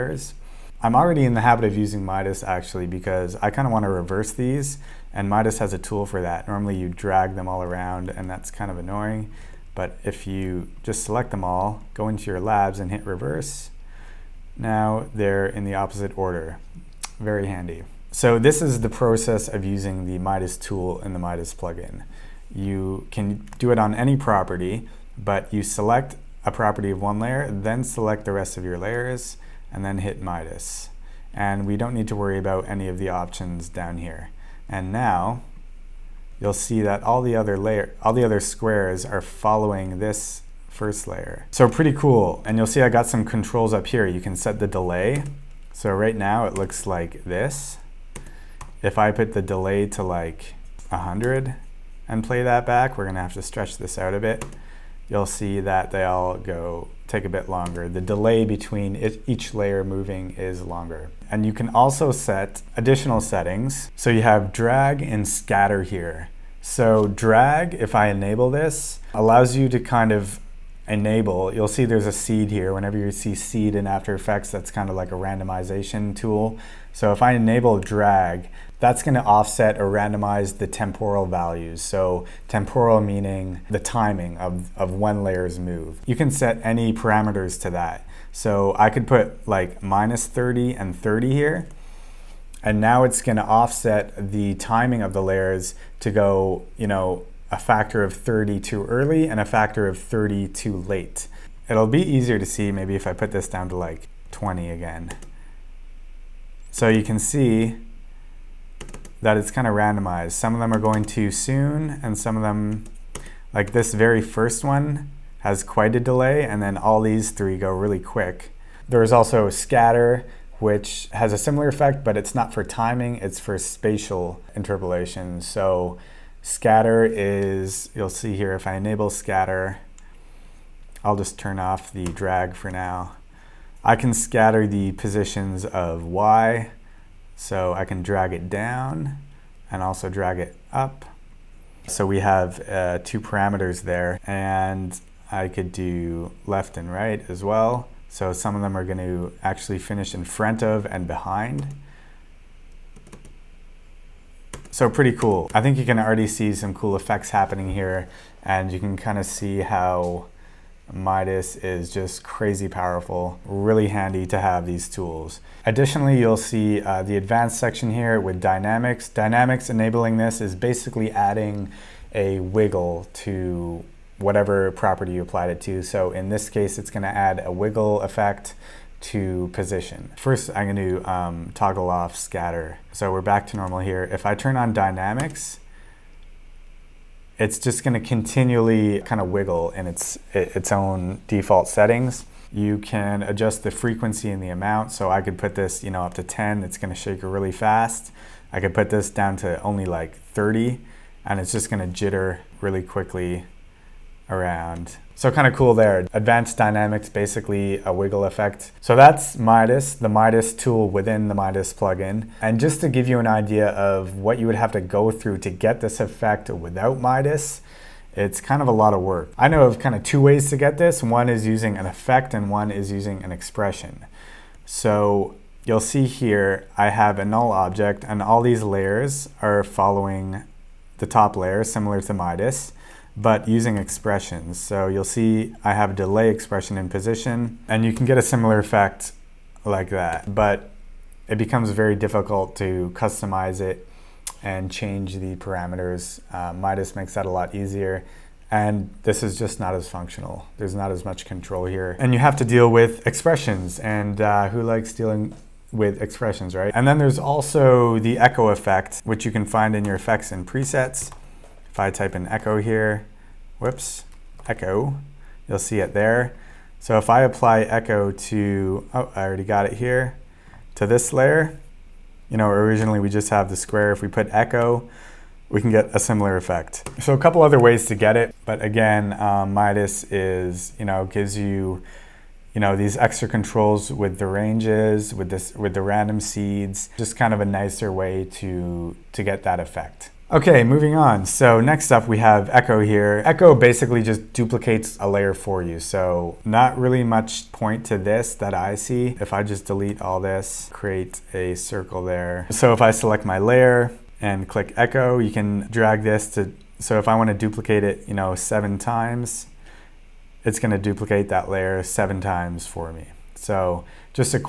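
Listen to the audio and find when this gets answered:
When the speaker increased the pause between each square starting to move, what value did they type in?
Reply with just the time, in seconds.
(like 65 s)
50 s.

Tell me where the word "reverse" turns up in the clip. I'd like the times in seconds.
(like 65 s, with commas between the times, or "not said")
3 s, 13 s.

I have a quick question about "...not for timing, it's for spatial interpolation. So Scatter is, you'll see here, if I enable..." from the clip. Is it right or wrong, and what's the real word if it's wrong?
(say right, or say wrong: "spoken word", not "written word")
right.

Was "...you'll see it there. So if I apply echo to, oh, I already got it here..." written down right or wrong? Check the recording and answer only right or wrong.
right.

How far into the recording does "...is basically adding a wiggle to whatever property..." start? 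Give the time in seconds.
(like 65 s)
170 s.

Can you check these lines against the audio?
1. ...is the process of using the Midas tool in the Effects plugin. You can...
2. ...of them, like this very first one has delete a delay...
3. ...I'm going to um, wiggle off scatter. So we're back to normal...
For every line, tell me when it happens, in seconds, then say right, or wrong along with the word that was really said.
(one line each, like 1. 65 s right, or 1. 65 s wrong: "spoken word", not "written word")
1. 18 s wrong: "Midas", not "Effects"
2. 112 s wrong: "quite", not "delete"
3. 180 s wrong: "toggle", not "wiggle".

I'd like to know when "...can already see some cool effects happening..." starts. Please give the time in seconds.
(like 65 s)
155 s.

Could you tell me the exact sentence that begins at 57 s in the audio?
The delay between it, each layer moving is longer.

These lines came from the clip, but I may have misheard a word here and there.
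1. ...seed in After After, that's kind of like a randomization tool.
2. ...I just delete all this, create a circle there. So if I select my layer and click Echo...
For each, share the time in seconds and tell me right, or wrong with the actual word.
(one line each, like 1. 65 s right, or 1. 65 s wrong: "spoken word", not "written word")
1. 73 s wrong: "Effects", not "After"
2. 299 s right.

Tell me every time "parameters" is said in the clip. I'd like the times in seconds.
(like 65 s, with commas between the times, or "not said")
86 s, 143 s, 245 s.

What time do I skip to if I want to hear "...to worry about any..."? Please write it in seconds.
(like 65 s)
32 s.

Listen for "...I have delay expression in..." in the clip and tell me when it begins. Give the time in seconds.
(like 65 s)
235 s.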